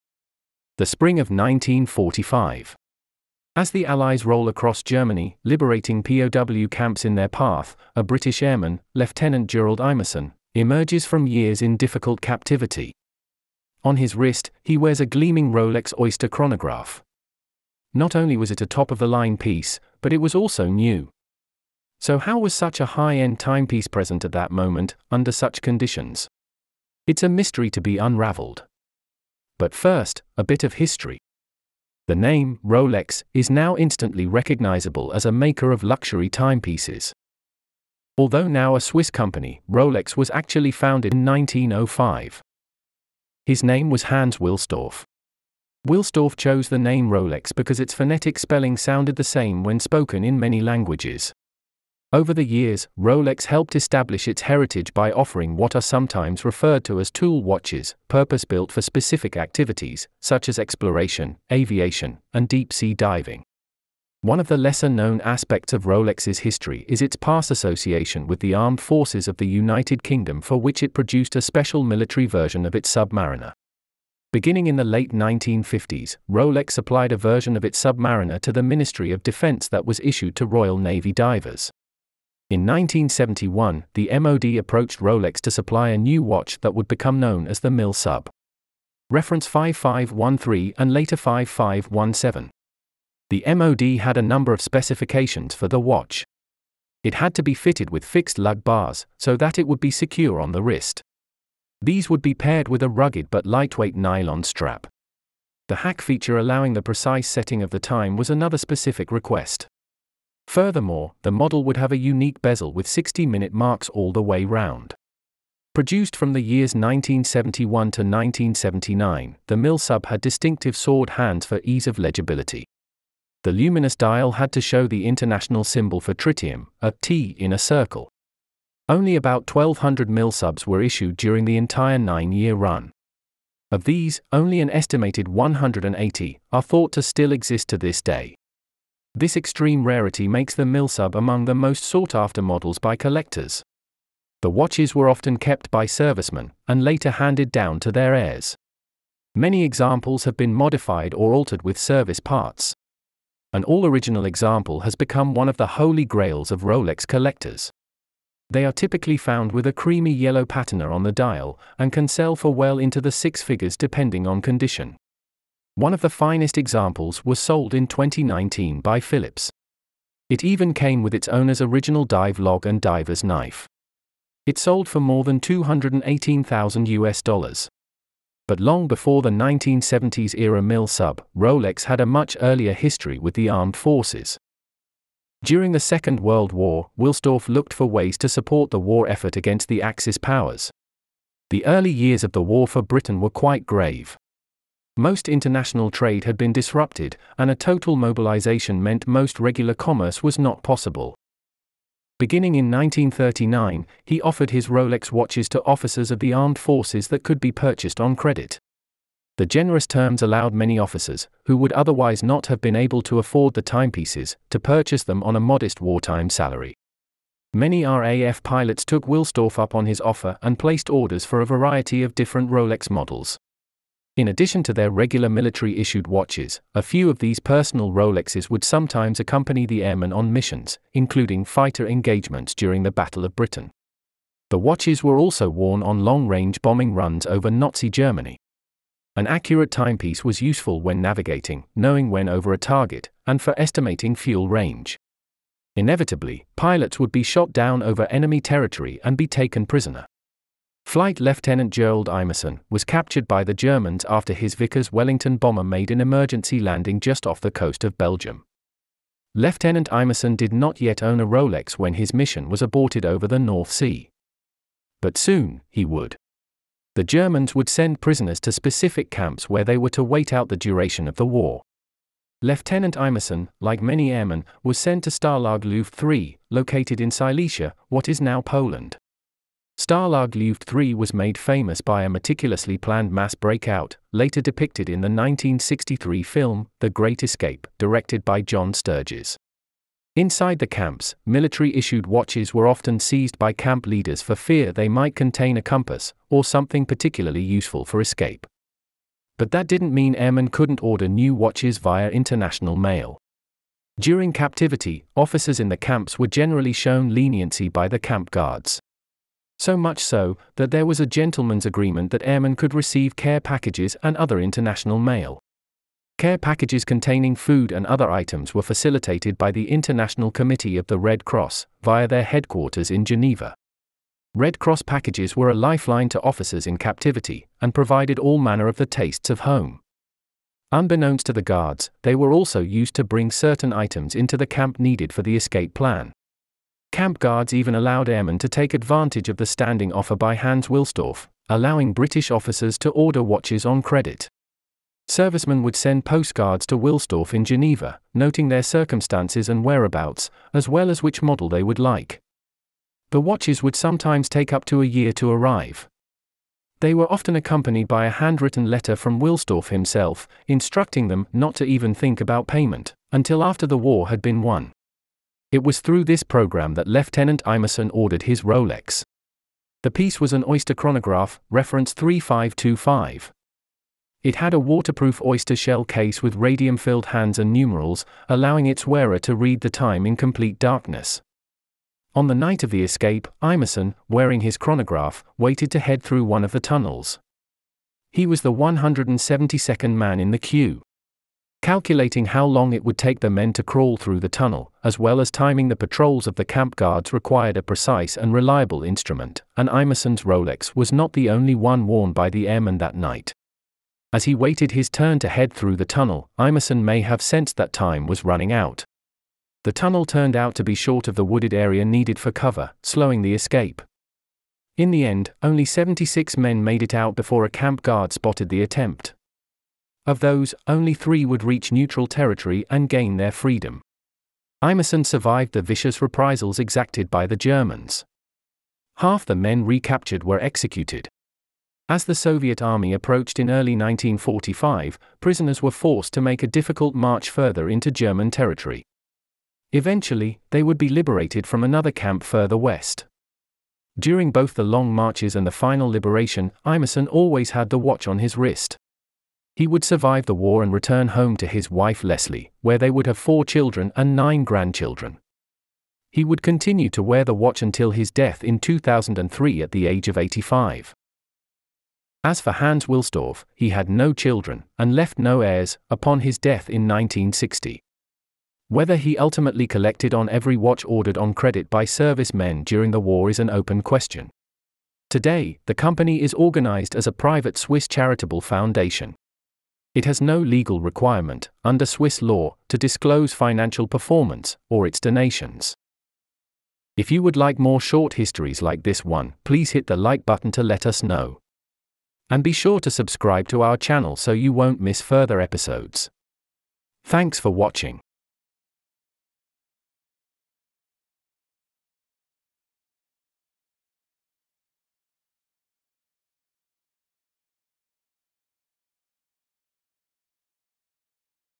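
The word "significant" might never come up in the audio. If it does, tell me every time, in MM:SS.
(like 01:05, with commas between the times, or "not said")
not said.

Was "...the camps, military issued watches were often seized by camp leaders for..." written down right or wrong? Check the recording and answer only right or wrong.
right.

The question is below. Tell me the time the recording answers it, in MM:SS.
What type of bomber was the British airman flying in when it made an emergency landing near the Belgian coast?
04:14.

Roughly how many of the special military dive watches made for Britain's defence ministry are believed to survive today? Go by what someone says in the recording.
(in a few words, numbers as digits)
180.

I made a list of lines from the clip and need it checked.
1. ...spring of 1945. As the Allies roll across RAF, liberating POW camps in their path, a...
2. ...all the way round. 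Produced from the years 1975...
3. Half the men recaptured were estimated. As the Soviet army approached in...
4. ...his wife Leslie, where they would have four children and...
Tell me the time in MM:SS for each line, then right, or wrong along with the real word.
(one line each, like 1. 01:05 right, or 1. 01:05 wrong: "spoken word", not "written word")
1. 00:00 wrong: "Germany", not "RAF"
2. 01:53 wrong: "1971", not "1975"
3. 07:08 wrong: "executed", not "estimated"
4. 07:31 right.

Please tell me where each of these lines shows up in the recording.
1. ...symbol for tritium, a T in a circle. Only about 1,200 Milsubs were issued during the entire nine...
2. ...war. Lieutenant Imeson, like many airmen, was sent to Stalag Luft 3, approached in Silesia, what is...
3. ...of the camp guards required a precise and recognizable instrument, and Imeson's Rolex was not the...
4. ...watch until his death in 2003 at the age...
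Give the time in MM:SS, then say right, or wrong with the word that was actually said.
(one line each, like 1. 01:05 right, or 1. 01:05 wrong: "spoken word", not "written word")
1. 02:05 right
2. 04:31 wrong: "located", not "approached"
3. 06:36 wrong: "reliable", not "recognizable"
4. 07:37 right.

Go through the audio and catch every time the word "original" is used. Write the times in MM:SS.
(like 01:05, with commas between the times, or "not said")
02:33, 02:51.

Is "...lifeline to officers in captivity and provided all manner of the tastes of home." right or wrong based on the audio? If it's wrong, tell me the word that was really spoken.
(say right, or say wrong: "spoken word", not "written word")
right.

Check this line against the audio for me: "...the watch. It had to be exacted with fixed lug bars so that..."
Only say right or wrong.
wrong.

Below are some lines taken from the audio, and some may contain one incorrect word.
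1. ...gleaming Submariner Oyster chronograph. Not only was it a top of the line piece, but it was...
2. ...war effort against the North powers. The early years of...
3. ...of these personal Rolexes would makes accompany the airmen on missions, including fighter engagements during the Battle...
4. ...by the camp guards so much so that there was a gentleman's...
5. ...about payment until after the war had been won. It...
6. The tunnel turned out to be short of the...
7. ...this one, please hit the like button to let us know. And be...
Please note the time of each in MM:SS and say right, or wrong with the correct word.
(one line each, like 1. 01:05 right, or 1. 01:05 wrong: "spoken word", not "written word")
1. 00:15 wrong: "Rolex", not "Submariner"
2. 03:08 wrong: "Axis", not "North"
3. 03:47 wrong: "sometimes", not "makes"
4. 05:07 right
5. 06:02 right
6. 06:49 right
7. 08:08 right.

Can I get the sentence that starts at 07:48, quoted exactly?
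Whether he ultimately collected on every watch ordered on credit by servicemen during the war is an open question.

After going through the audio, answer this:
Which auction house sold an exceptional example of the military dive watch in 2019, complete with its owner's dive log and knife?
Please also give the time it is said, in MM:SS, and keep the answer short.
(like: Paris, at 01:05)
Phillips, at 02:48.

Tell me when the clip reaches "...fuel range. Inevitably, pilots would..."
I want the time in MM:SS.
04:04.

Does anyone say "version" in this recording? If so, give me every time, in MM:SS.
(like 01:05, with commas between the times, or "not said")
01:12, 01:17.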